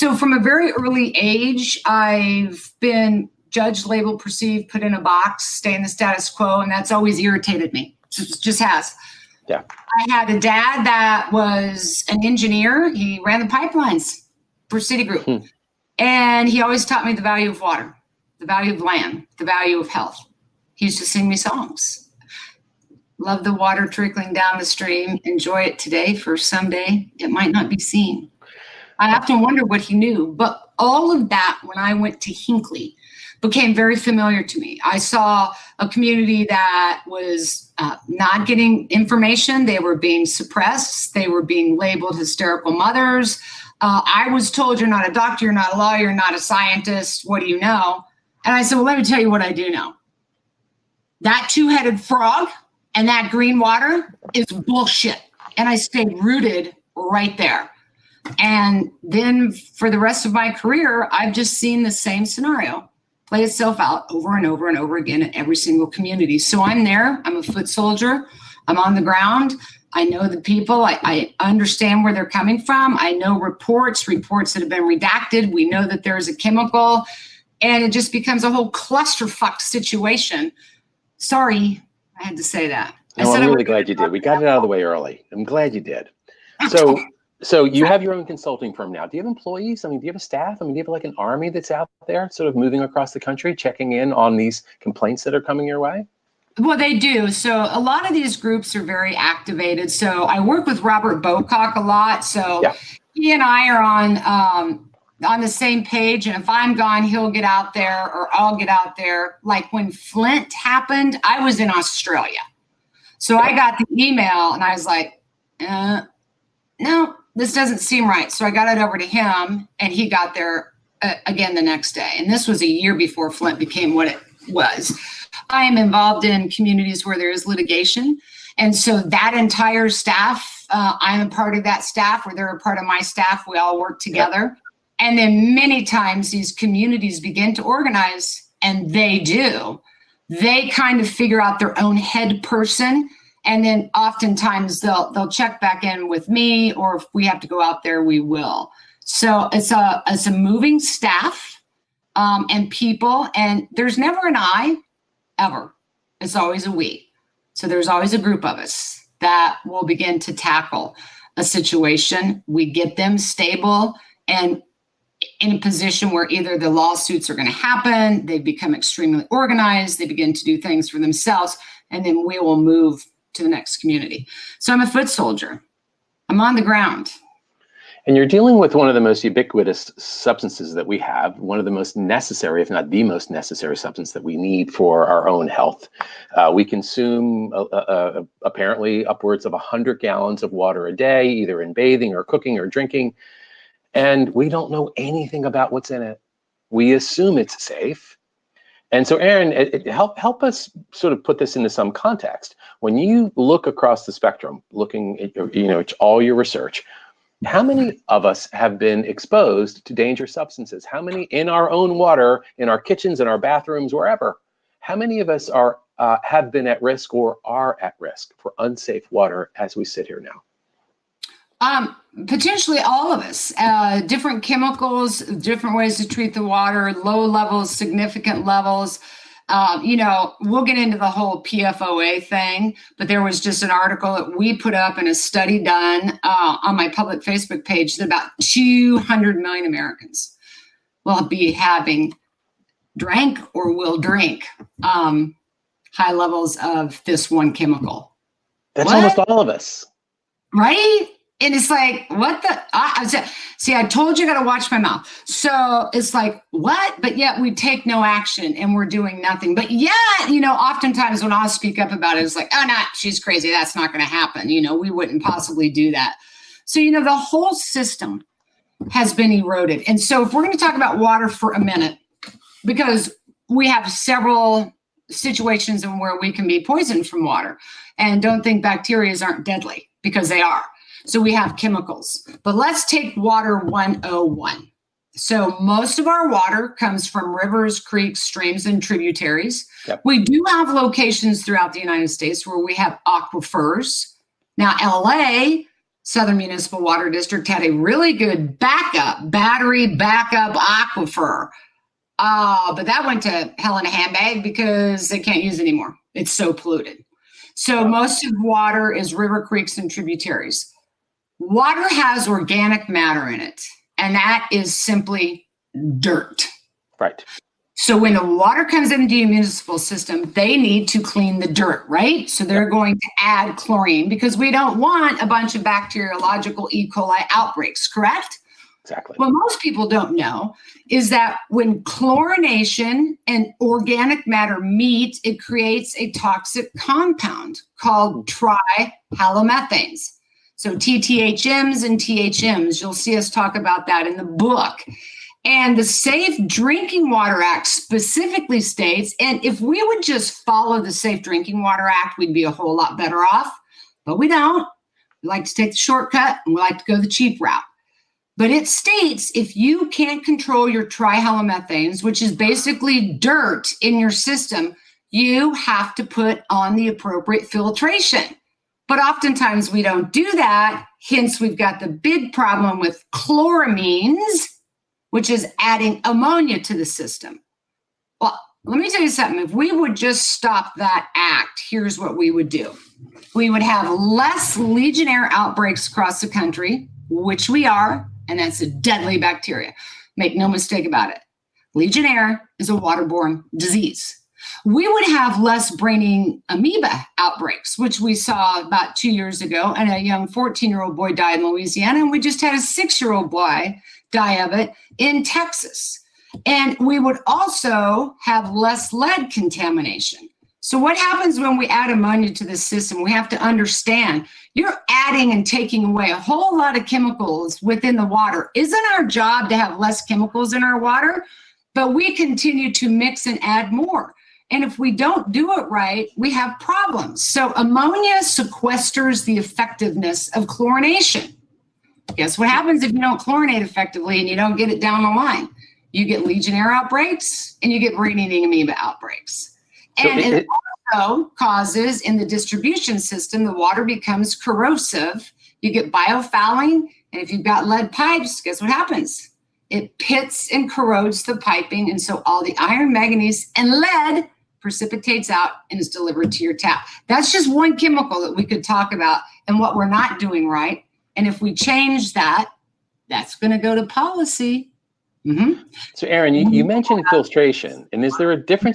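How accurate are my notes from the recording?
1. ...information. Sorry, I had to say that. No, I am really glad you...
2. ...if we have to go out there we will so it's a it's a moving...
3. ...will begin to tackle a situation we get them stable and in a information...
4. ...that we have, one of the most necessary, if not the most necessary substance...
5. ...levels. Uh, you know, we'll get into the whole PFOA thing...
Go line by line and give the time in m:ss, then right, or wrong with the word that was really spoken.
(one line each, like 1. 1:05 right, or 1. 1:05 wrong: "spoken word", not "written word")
1. 1:19 wrong: "situation", not "information"
2. 2:26 right
3. 2:39 wrong: "position", not "information"
4. 3:00 right
5. 3:48 right.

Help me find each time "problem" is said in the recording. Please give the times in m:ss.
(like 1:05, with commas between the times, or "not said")
6:12, 7:06.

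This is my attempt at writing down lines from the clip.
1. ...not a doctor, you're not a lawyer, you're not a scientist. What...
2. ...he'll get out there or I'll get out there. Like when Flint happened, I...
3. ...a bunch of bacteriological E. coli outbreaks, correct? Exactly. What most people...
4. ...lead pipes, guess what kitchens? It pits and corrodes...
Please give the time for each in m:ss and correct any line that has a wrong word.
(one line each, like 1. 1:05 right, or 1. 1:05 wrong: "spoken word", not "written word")
1. 0:44 right
2. 1:47 right
3. 5:25 right
4. 7:27 wrong: "happens", not "kitchens".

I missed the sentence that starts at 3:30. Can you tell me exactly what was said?
How many in our own water, in our kitchens, in our bathrooms, wherever?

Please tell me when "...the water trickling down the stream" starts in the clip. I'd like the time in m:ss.
0:23.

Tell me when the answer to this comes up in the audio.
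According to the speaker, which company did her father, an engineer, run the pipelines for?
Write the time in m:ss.
0:14.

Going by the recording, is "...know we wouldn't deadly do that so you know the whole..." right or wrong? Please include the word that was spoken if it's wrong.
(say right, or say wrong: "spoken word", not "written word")
wrong: "possibly", not "deadly".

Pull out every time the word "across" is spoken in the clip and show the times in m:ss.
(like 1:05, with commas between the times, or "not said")
1:32, 3:23, 6:25.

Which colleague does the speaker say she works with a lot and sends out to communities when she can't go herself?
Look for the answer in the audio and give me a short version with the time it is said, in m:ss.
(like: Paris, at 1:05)
Robert Bowcock, at 1:40.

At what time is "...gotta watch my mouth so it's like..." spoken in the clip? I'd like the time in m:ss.
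4:14.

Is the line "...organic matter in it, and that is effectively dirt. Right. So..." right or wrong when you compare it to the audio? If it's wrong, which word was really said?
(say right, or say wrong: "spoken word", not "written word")
wrong: "simply", not "effectively".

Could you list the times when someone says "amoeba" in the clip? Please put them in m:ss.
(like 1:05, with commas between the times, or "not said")
6:36, 7:18.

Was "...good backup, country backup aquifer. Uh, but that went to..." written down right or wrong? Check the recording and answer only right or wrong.
wrong.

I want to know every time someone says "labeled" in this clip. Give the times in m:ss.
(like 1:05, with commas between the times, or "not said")
0:03, 0:41.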